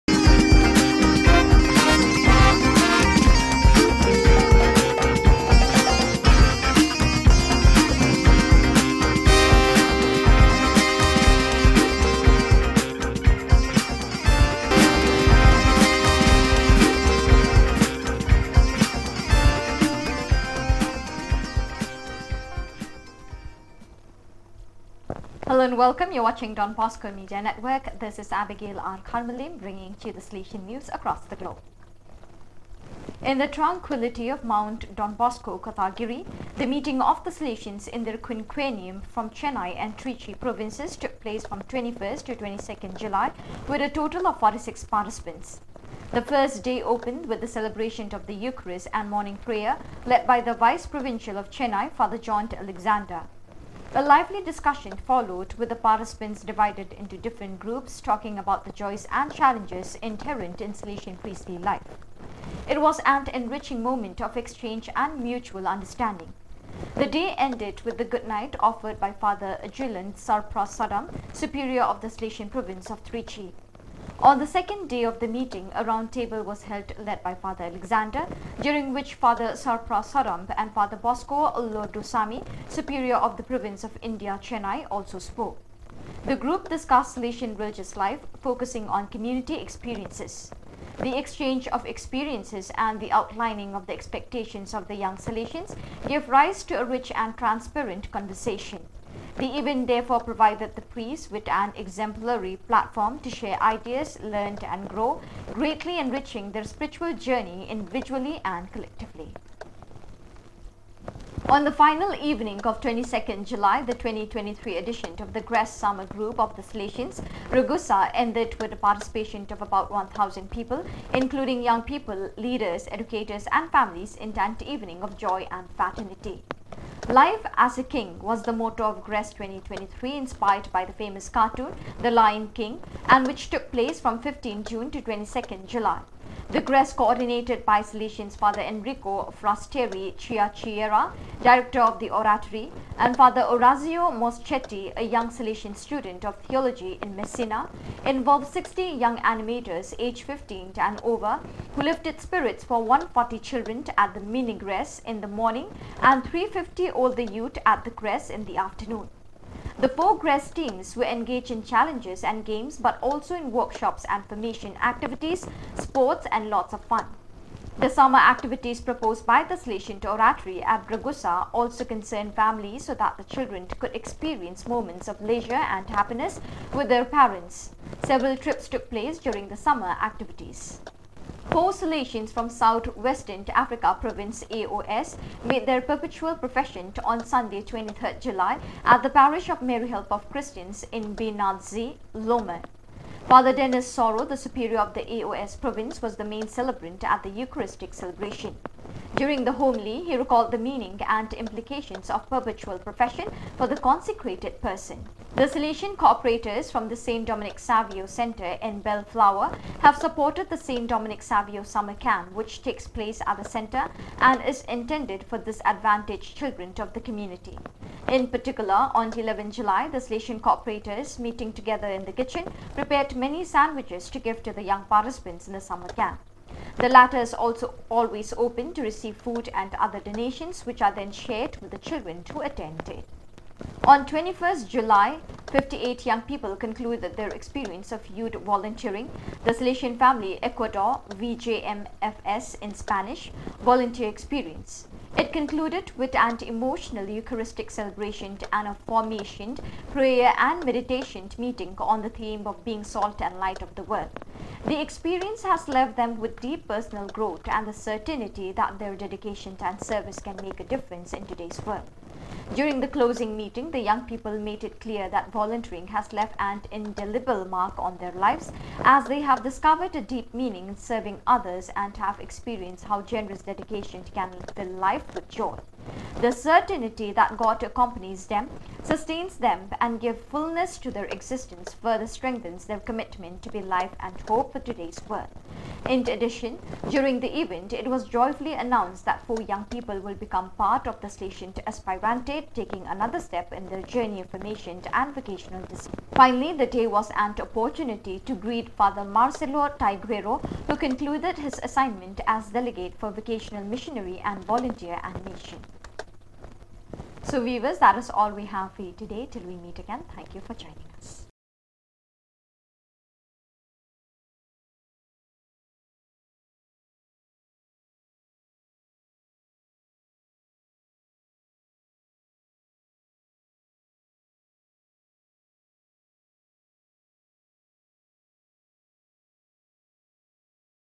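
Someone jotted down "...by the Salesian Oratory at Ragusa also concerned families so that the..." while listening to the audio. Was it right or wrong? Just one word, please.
right.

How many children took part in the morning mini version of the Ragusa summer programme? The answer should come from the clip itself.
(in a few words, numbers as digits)
140.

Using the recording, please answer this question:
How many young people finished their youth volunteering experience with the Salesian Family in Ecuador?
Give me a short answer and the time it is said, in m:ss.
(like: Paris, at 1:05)
58, at 3:55.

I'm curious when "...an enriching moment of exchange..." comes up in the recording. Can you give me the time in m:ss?
1:03.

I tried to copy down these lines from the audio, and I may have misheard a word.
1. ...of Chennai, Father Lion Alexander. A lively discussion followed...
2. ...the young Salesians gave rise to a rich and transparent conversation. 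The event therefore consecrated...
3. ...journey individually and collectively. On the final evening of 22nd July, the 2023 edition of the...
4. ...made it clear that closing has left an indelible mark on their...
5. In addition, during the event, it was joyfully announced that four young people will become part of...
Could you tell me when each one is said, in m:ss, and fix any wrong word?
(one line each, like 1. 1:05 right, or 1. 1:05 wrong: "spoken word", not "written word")
1. 0:51 wrong: "John", not "Lion"
2. 1:34 wrong: "provided", not "consecrated"
3. 1:47 right
4. 4:24 wrong: "volunteering", not "closing"
5. 4:45 right.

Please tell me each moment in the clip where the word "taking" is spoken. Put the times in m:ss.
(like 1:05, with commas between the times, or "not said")
4:52.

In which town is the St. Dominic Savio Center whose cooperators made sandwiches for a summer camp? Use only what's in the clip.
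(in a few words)
Bellflower.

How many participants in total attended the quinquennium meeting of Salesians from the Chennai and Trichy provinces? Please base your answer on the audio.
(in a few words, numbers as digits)
46.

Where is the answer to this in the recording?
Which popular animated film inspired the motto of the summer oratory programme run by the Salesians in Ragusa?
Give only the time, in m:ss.
2:11.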